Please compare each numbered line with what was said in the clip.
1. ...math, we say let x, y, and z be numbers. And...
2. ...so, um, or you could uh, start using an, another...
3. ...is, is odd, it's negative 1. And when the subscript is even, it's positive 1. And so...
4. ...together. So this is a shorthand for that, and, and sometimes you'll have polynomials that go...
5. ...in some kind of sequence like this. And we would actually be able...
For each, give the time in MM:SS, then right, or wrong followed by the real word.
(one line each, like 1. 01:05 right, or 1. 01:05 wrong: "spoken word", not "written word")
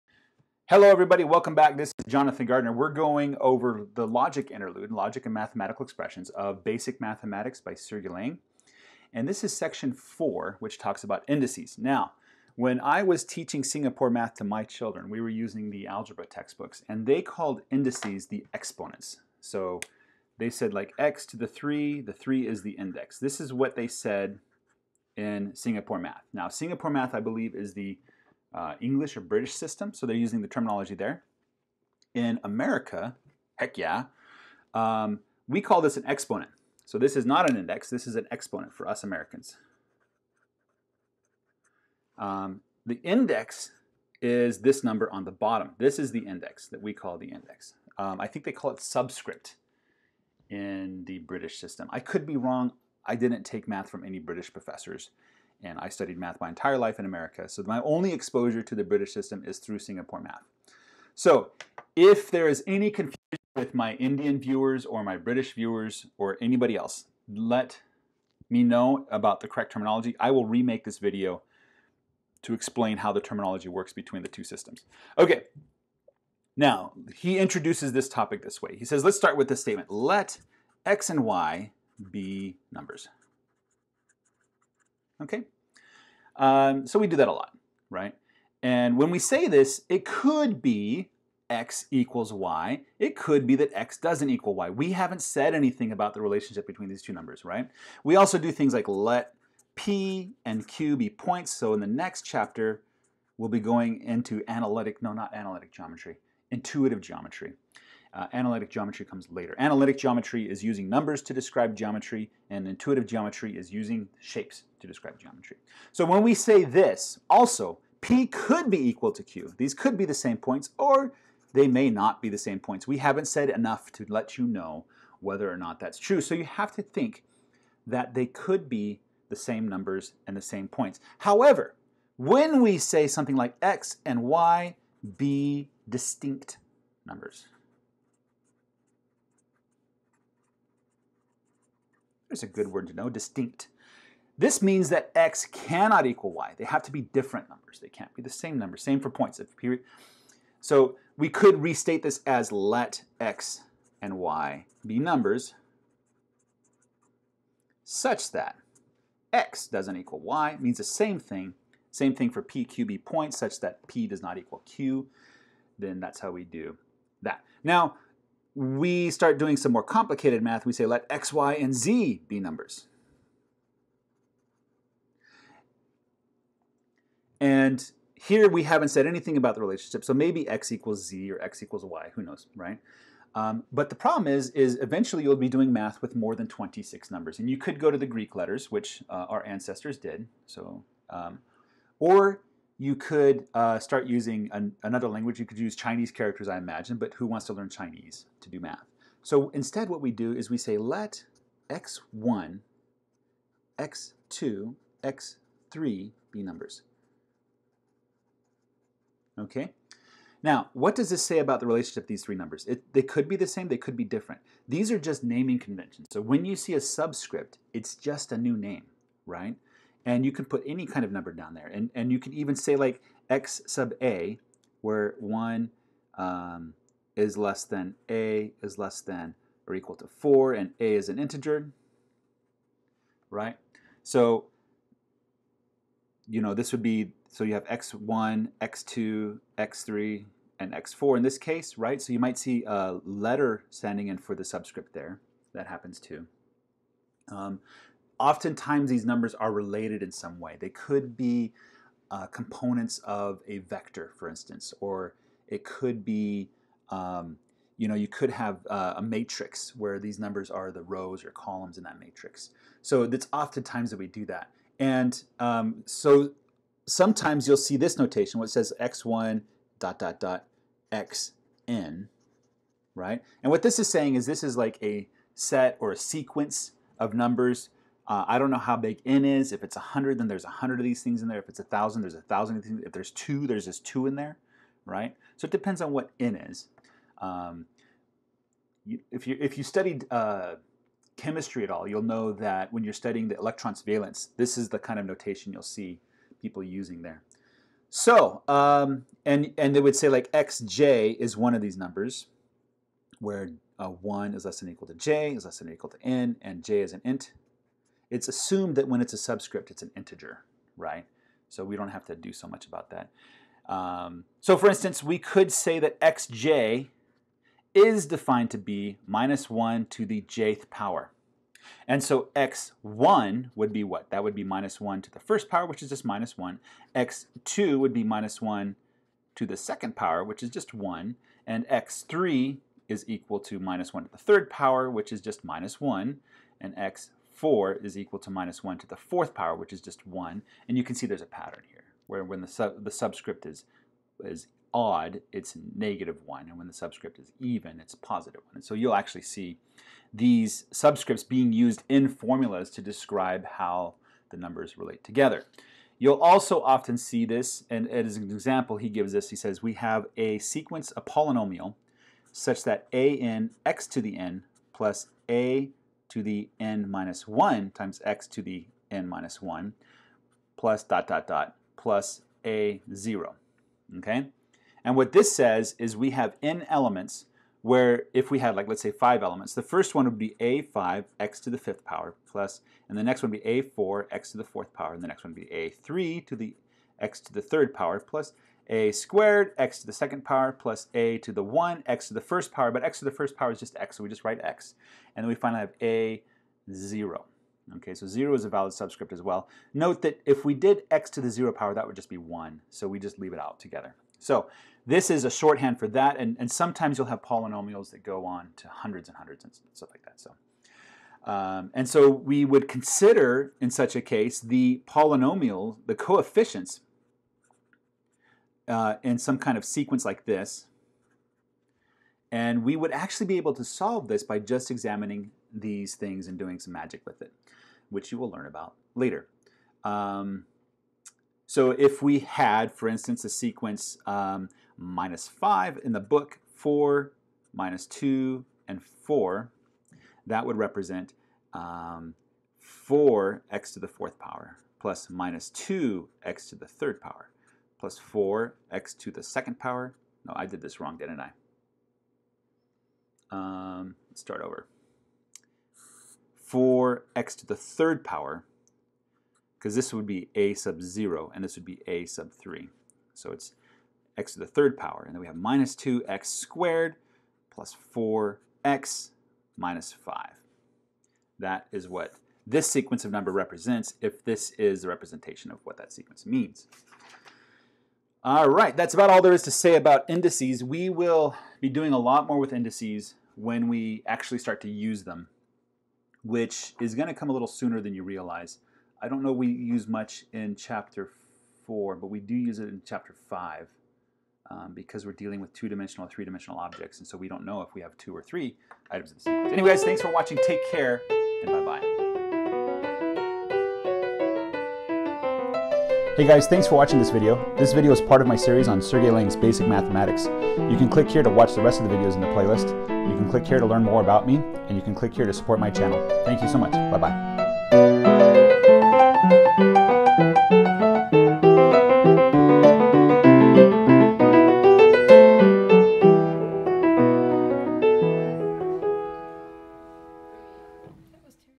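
1. 02:50 right
2. 03:10 right
3. 05:43 right
4. 06:43 right
5. 06:59 right.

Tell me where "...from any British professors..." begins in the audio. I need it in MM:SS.
00:53.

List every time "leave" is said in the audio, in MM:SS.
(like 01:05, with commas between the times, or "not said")
06:43.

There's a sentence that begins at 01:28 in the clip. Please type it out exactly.
And when we say this, it could be x equals y.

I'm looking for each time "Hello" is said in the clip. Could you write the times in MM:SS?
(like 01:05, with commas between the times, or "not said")
00:00.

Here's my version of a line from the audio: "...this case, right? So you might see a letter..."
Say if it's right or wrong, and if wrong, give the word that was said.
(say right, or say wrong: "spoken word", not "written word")
right.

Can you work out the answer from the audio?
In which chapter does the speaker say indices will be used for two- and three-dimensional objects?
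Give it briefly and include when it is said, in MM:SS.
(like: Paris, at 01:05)
chapter 5, at 08:12.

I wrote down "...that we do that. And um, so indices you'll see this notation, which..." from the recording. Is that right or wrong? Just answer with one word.
wrong.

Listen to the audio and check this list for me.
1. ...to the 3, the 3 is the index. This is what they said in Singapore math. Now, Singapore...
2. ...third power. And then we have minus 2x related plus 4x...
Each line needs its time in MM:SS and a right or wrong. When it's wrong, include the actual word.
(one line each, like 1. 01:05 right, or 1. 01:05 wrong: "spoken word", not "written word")
1. 00:21 right
2. 07:44 wrong: "squared", not "related".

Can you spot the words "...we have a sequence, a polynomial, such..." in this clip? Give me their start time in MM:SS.
05:59.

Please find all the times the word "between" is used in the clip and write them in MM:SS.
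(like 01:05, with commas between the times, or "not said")
01:13, 01:36.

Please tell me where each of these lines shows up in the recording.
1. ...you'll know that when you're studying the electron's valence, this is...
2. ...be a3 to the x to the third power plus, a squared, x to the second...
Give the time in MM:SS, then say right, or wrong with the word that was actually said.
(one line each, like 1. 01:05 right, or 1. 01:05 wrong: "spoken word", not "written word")
1. 04:51 right
2. 06:25 right.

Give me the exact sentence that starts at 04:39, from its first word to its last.
If it's 100, then there's 100 of these things in there.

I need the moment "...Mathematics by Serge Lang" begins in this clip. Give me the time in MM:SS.
00:07.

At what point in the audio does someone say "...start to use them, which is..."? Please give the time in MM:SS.
08:04.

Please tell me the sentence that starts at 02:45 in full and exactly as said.
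Then that's how we do that.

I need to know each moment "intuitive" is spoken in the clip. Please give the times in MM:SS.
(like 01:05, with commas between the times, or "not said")
01:46, 01:52.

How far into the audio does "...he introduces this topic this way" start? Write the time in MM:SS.
01:17.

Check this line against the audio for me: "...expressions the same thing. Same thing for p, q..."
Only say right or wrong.
wrong.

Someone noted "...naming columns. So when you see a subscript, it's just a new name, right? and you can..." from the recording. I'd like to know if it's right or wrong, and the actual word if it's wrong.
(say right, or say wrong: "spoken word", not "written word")
wrong: "conventions", not "columns".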